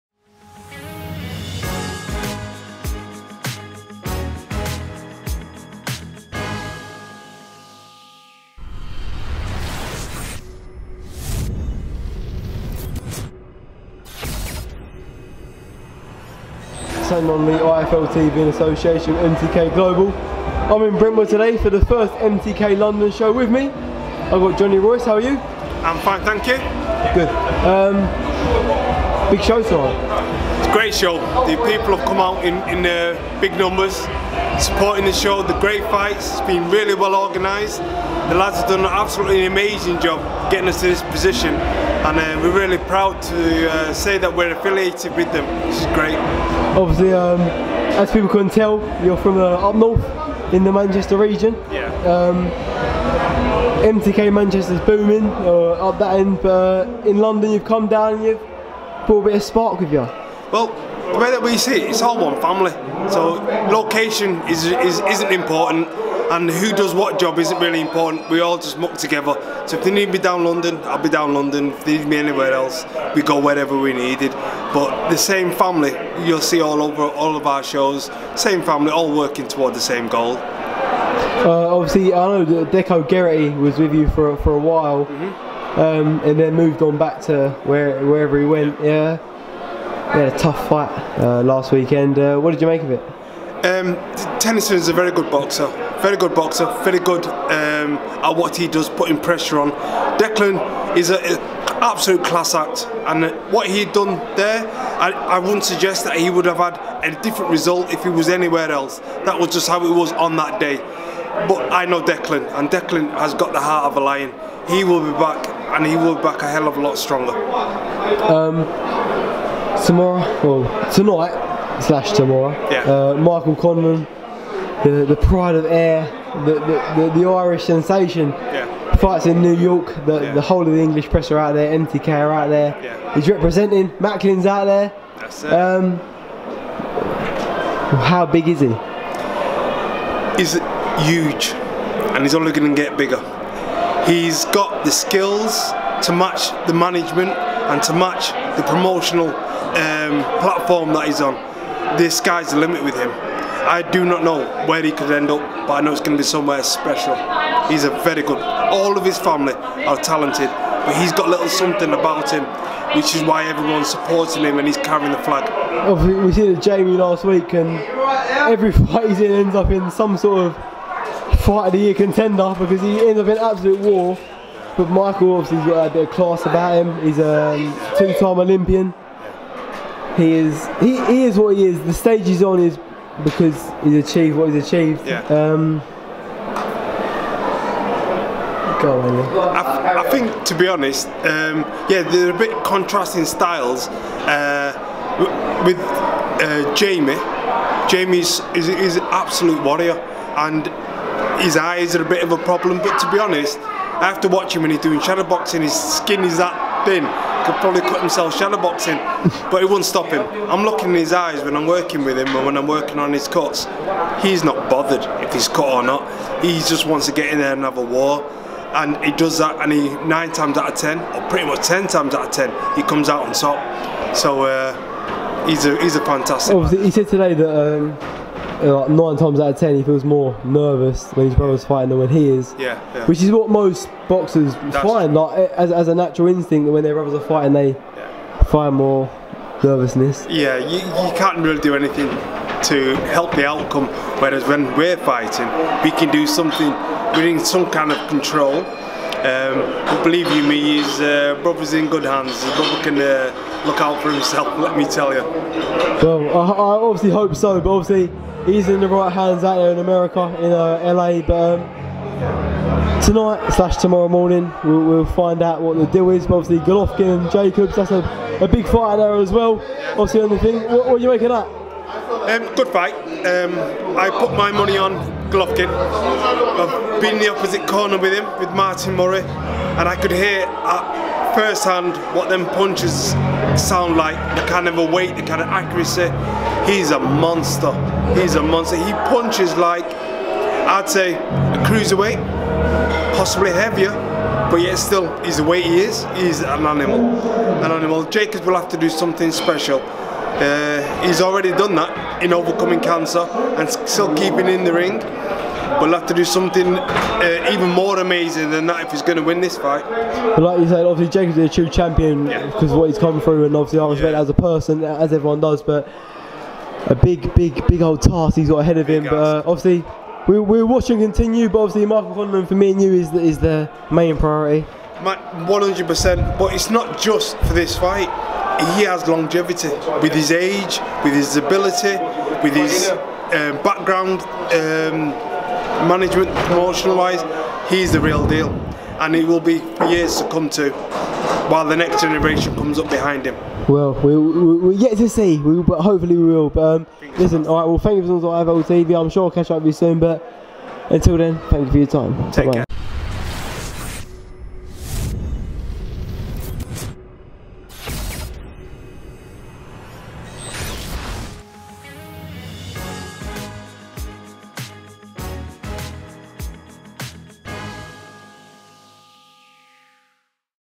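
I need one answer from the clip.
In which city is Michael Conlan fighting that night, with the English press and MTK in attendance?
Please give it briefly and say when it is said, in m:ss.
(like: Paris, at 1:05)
New York, at 2:09.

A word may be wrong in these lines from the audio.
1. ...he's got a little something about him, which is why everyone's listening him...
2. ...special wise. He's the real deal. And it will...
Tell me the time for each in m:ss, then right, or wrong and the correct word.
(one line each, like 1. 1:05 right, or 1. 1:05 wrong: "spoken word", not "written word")
1. 2:40 wrong: "supporting", not "listening"
2. 5:36 wrong: "promotional", not "special".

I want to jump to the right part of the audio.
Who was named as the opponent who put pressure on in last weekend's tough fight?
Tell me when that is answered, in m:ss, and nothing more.
1:34.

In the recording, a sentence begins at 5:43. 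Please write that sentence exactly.
Well, we, we, we're yet to see, we, but hopefully we will.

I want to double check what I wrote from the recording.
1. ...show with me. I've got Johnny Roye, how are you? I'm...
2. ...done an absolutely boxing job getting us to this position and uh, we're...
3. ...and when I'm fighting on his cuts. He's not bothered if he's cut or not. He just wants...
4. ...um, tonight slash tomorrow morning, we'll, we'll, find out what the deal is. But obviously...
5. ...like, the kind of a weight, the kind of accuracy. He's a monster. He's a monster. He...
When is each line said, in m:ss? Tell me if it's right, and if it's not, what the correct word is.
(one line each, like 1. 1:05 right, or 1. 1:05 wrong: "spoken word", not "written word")
1. 0:23 right
2. 0:38 wrong: "amazing", not "boxing"
3. 3:32 wrong: "working", not "fighting"
4. 4:21 right
5. 4:43 right.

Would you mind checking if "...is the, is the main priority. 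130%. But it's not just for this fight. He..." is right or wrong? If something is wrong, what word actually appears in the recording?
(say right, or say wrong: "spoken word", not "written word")
wrong: "100", not "130".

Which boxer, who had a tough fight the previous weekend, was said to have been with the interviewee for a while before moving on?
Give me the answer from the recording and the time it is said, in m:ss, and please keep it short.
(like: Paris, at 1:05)
Deco Geraghty, at 1:22.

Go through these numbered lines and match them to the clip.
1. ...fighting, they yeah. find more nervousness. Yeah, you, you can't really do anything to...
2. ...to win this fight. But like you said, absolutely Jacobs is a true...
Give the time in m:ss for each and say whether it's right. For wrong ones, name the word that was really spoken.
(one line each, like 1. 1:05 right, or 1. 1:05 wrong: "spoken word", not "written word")
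1. 3:57 right
2. 5:09 wrong: "obviously", not "absolutely".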